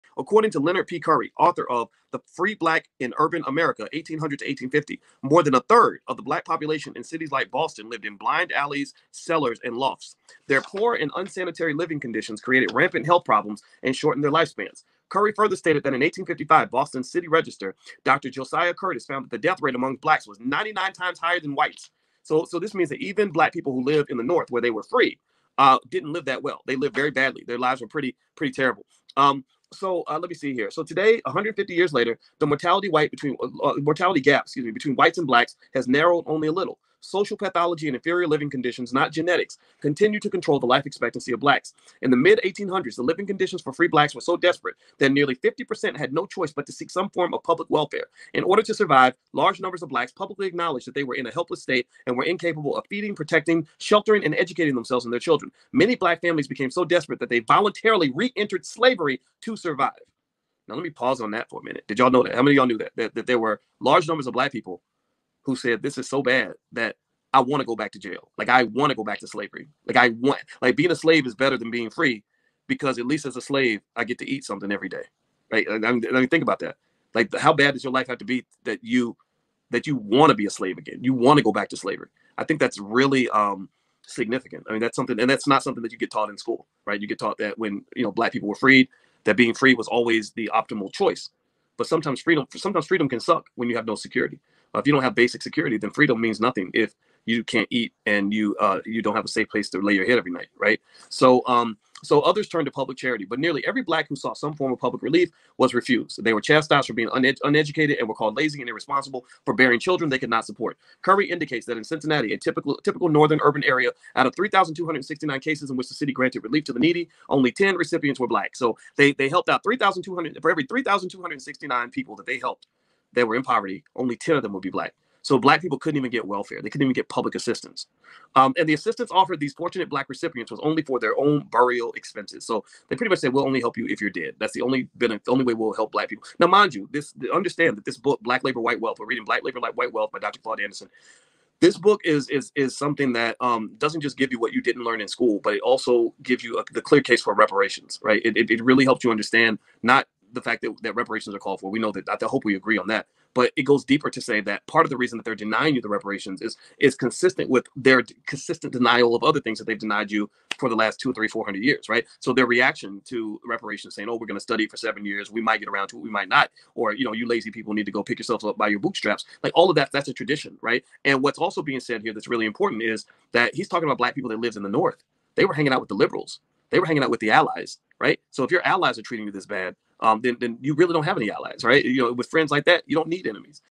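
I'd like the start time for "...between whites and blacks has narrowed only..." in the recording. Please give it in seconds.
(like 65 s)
34 s.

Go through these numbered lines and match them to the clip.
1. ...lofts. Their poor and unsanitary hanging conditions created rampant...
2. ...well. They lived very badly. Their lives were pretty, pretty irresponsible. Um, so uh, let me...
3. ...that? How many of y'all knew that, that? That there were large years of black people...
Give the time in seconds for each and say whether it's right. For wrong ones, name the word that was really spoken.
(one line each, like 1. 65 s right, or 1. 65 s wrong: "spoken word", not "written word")
1. 9 s wrong: "living", not "hanging"
2. 26 s wrong: "terrible", not "irresponsible"
3. 62 s wrong: "numbers", not "years".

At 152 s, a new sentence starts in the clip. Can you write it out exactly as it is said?
I hope we agree on that.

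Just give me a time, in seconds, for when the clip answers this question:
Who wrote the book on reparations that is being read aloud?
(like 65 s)
140 s.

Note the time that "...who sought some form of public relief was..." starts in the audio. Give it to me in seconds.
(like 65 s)
104 s.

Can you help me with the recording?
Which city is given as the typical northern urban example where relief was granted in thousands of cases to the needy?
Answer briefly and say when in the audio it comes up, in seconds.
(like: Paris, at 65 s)
Cincinnati, at 111 s.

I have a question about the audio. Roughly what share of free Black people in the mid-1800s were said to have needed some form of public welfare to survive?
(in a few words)
50%.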